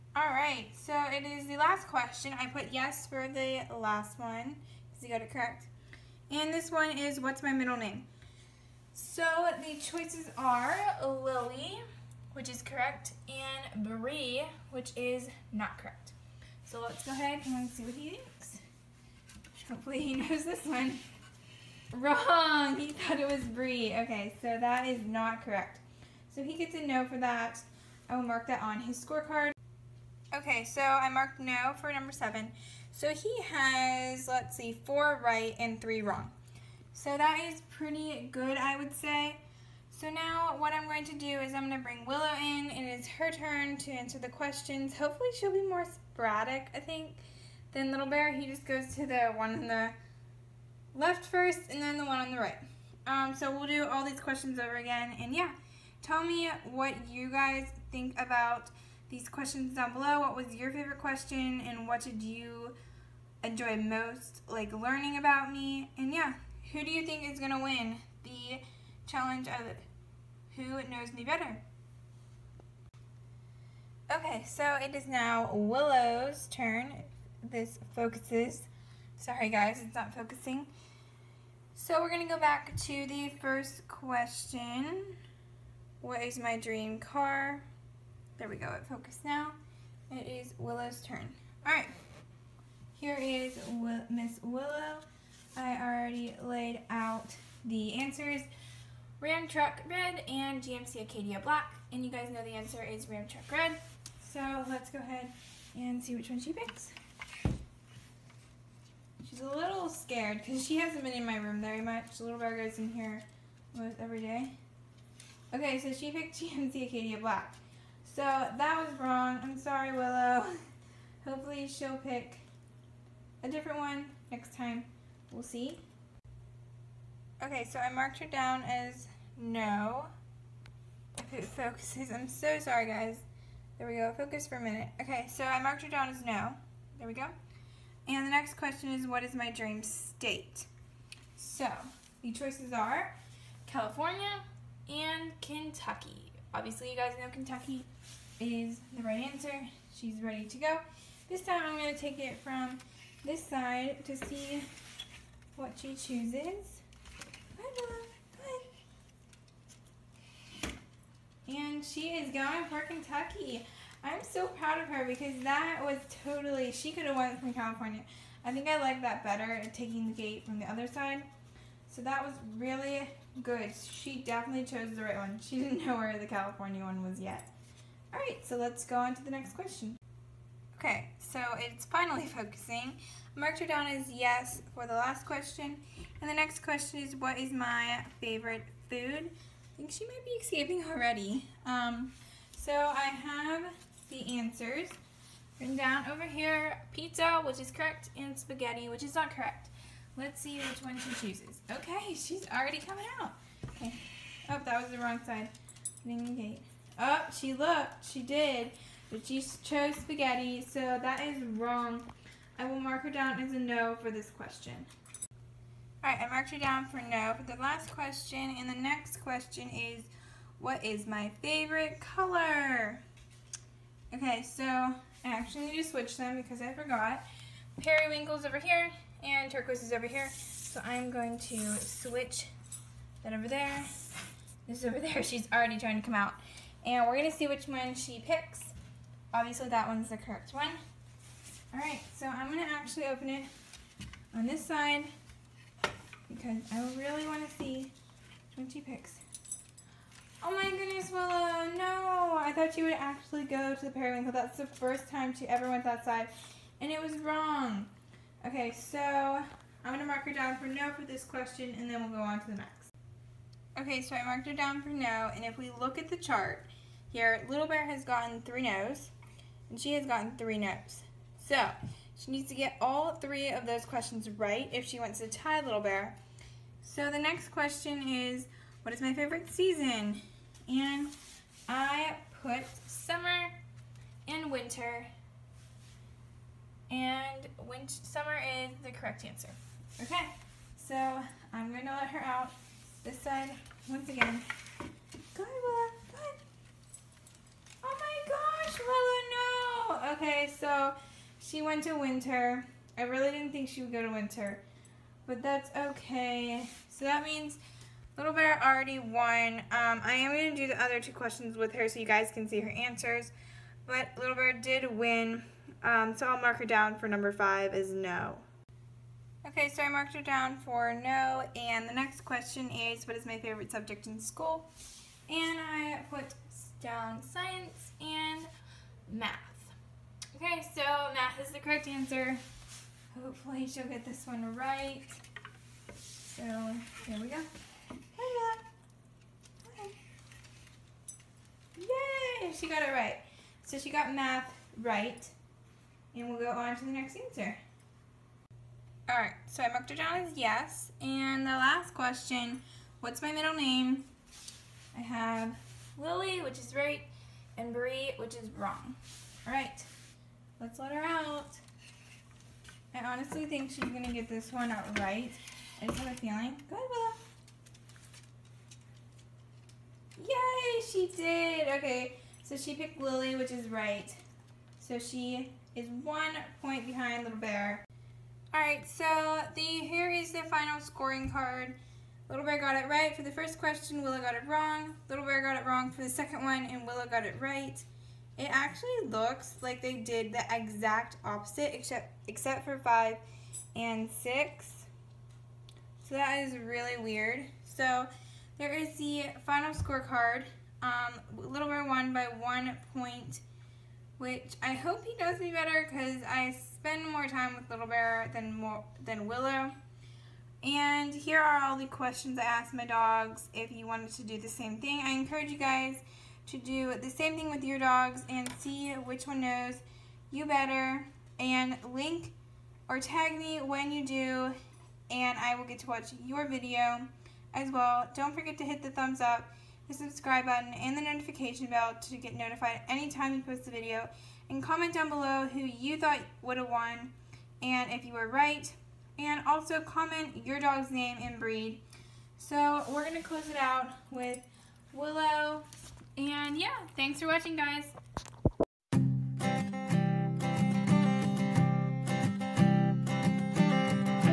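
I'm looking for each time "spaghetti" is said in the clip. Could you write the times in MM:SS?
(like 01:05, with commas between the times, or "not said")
03:18, 03:29.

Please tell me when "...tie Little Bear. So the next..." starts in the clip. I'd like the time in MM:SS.
04:35.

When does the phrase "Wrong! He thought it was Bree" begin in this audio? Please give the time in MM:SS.
00:21.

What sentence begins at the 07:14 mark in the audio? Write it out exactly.
And comment down below who you thought would have won and if you were right.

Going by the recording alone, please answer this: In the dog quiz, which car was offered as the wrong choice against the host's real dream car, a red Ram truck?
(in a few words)
GMC Acadia Black.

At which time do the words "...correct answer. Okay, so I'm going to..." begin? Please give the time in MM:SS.
04:48.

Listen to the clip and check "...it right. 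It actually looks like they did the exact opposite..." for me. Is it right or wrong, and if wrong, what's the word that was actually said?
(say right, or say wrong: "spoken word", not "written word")
right.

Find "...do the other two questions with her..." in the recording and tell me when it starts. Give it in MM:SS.
05:10.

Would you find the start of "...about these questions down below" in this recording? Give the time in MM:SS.
00:58.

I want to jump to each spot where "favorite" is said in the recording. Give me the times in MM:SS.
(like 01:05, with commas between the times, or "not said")
01:00, 03:08, 03:41, 04:39, 05:23.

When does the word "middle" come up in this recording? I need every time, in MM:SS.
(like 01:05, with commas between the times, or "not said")
00:07, 05:53.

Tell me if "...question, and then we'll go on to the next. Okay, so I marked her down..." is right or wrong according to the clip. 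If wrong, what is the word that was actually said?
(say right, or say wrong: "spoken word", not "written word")
right.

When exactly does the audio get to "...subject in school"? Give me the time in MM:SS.
05:23.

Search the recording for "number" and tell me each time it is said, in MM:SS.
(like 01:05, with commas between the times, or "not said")
00:31, 05:17.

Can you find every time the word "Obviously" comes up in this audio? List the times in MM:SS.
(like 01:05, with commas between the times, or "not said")
02:26, 03:59.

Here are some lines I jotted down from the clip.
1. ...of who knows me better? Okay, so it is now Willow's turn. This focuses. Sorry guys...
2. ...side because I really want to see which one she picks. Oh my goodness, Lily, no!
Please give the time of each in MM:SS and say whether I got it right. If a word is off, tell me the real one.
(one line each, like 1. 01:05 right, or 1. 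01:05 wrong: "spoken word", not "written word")
1. 01:09 right
2. 04:04 wrong: "Willow", not "Lily".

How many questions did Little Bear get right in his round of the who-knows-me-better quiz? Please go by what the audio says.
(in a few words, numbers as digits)
4.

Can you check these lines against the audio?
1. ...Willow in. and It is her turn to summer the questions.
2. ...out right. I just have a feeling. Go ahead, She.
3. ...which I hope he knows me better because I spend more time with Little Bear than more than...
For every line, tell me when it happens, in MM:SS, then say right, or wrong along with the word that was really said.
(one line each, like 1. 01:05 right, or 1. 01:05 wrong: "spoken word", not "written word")
1. 00:42 wrong: "answer", not "summer"
2. 06:04 wrong: "Willow", not "She"
3. 06:44 right.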